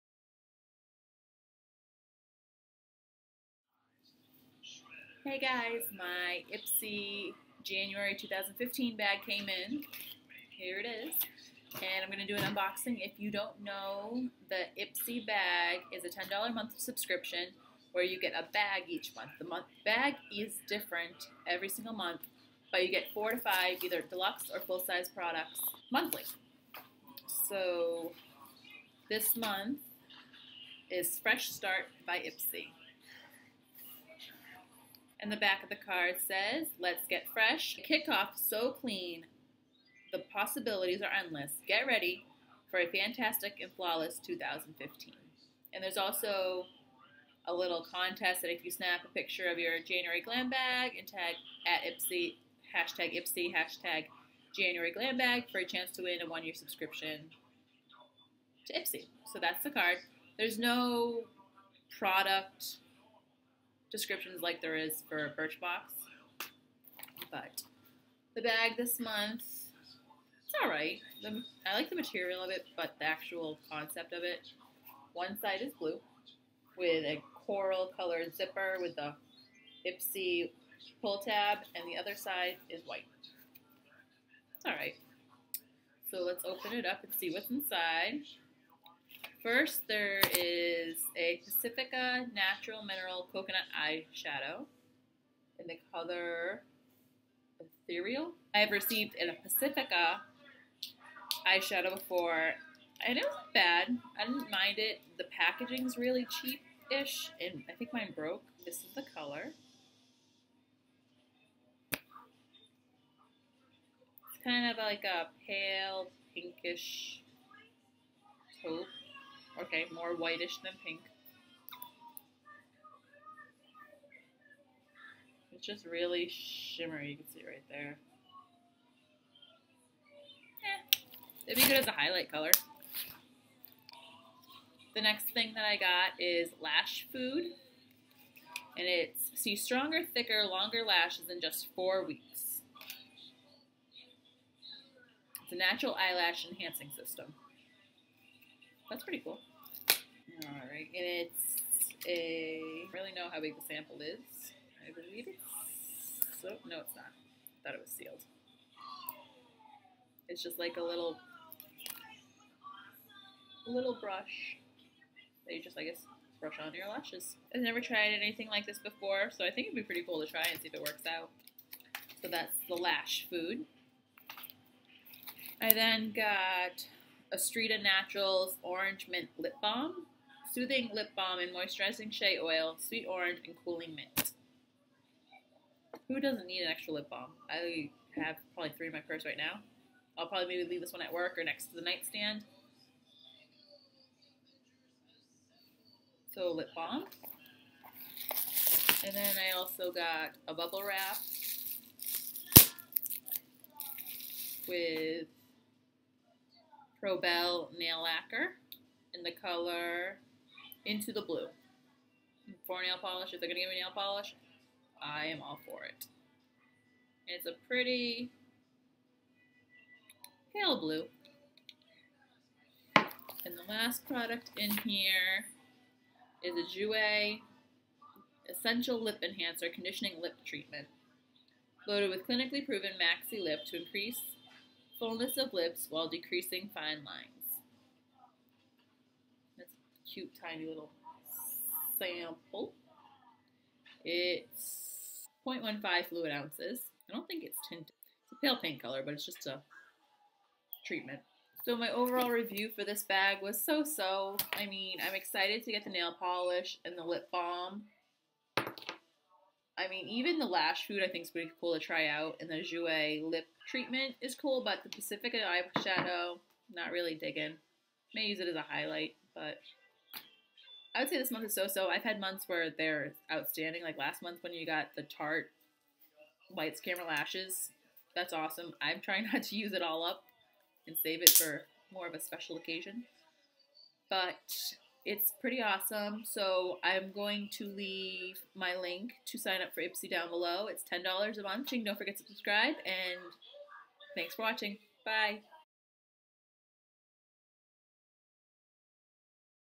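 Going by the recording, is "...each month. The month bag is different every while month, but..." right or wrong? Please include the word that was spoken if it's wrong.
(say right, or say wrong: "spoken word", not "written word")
wrong: "single", not "while".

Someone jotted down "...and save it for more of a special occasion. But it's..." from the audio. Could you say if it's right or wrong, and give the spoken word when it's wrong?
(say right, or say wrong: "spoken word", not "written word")
right.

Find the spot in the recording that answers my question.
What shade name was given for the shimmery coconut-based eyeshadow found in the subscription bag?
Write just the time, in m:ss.
1:37.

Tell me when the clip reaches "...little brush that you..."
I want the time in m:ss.
2:43.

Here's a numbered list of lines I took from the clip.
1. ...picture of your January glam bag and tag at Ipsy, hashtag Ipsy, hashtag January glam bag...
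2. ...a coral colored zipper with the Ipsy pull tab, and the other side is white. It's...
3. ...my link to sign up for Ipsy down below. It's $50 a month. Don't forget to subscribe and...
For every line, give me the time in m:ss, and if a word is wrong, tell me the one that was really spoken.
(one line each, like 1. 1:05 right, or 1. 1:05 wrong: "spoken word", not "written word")
1. 0:49 right
2. 1:17 right
3. 4:48 wrong: "10", not "50".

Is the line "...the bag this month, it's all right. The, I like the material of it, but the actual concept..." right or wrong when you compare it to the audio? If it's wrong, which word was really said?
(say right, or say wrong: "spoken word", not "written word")
right.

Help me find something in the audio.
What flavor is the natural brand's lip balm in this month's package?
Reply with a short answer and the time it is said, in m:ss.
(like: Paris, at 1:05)
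Orange Mint, at 2:58.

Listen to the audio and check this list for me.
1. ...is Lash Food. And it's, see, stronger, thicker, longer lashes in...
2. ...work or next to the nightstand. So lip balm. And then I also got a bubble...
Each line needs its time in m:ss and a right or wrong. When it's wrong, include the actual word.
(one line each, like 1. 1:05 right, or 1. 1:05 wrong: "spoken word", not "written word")
1. 2:16 right
2. 3:11 right.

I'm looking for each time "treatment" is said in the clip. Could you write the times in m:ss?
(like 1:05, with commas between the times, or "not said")
3:50, 4:10, 4:23.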